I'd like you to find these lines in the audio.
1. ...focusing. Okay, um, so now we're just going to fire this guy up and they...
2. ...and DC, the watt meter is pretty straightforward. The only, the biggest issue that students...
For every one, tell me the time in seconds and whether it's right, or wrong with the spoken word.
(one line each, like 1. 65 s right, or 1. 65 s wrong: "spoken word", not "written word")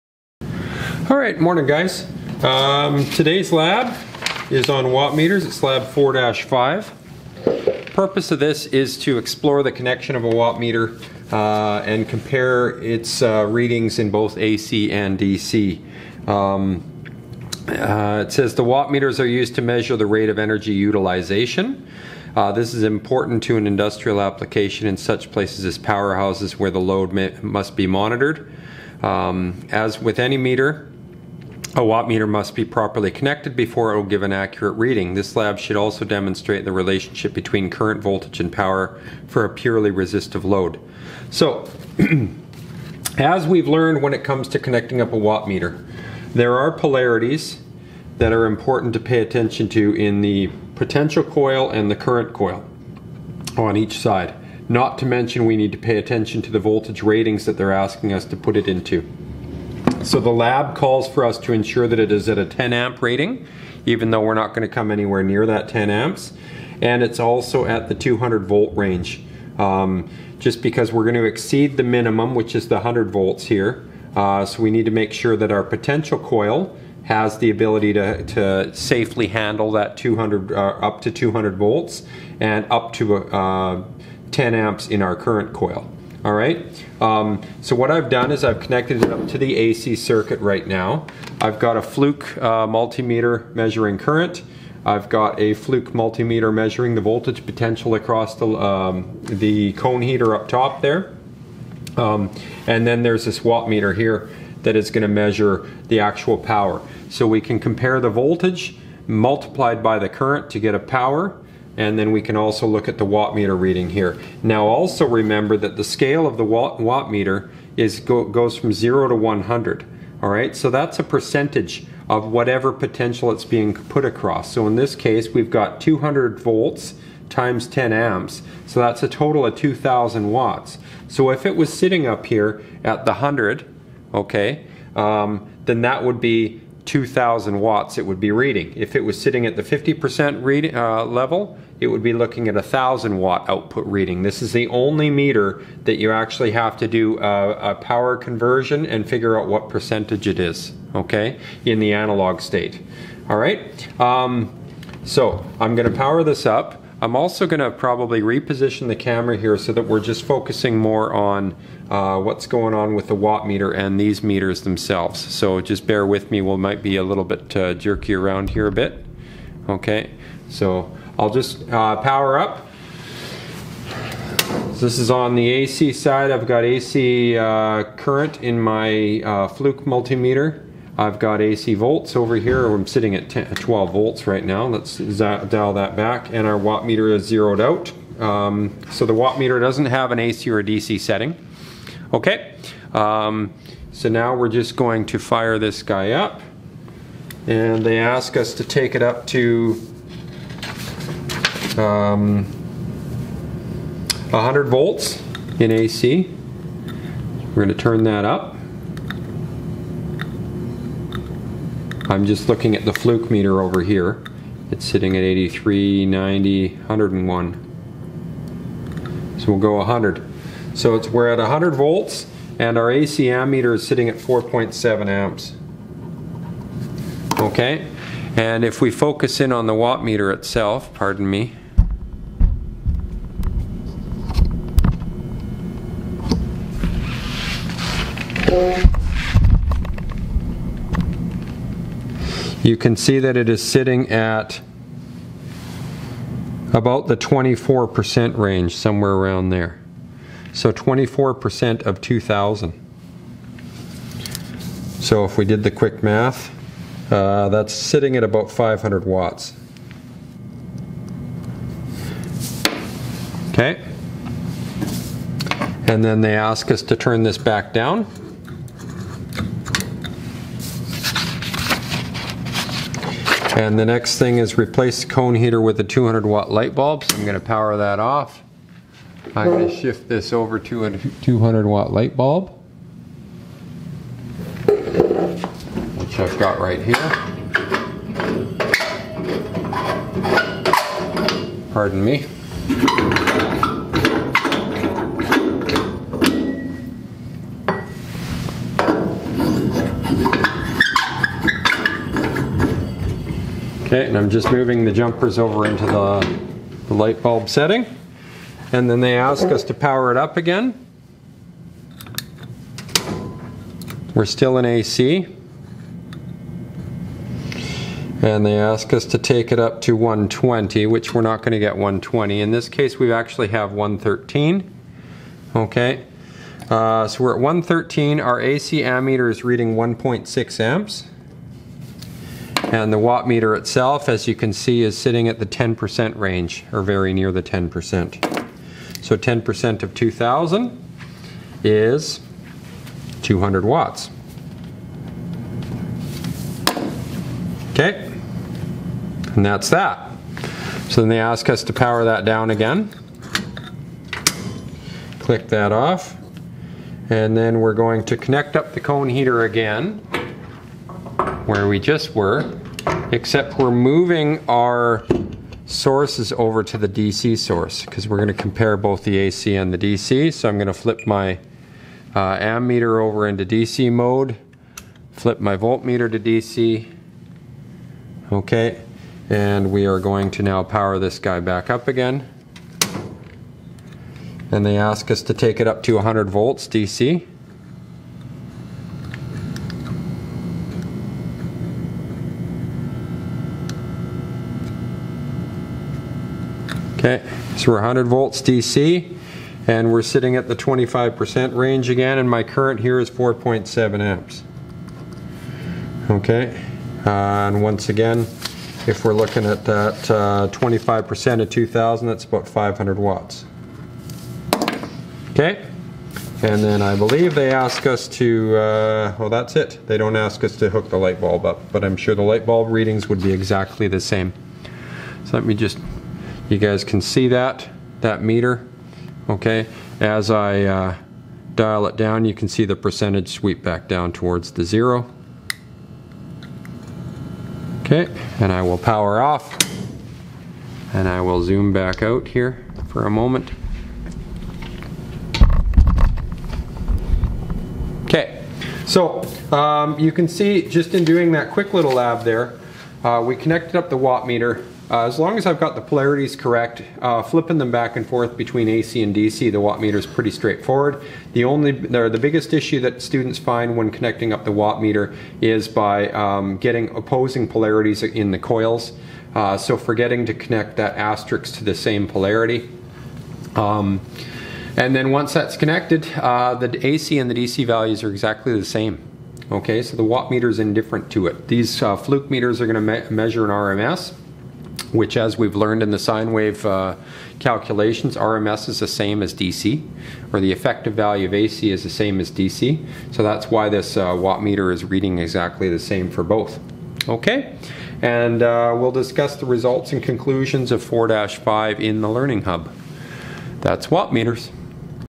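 1. 190 s wrong: "setting", not "focusing"
2. 459 s right.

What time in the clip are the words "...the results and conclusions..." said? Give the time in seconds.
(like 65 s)
499 s.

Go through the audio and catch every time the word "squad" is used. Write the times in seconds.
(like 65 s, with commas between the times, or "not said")
not said.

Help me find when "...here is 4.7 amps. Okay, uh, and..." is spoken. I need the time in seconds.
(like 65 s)
402 s.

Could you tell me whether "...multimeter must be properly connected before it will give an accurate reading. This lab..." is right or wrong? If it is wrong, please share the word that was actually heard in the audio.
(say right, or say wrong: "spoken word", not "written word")
wrong: "meter", not "multimeter".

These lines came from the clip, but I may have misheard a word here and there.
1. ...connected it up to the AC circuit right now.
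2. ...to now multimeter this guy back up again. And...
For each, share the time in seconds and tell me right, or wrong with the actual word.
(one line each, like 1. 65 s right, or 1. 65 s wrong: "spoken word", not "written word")
1. 88 s right
2. 380 s wrong: "power", not "multimeter".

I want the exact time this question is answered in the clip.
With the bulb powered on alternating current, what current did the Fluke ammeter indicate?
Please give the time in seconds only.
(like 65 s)
329 s.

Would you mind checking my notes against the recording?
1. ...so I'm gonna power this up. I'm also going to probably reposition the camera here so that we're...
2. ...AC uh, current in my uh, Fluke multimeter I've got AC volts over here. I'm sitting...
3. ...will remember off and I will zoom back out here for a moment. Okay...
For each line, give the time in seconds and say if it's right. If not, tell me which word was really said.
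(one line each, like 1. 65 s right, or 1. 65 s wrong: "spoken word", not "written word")
1. 155 s right
2. 176 s right
3. 438 s wrong: "power", not "remember".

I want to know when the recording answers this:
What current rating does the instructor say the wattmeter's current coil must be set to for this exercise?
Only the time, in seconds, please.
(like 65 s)
62 s.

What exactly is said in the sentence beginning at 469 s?
Uh, so forgetting to connect that asterisk to the same polarity.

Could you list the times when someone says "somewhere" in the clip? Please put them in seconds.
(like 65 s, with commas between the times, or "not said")
248 s.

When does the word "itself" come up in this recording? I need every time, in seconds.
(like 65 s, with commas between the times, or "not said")
230 s, 333 s.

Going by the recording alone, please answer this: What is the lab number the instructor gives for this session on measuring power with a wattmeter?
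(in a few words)
4-5.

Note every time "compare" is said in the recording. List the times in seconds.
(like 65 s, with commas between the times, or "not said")
12 s, 107 s, 368 s.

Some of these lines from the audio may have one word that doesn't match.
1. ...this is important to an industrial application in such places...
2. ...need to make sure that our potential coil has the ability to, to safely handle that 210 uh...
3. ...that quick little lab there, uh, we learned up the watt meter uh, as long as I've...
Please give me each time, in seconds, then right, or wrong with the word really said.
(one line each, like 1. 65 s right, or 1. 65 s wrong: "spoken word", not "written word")
1. 22 s right
2. 74 s wrong: "200", not "210"
3. 451 s wrong: "connected", not "learned".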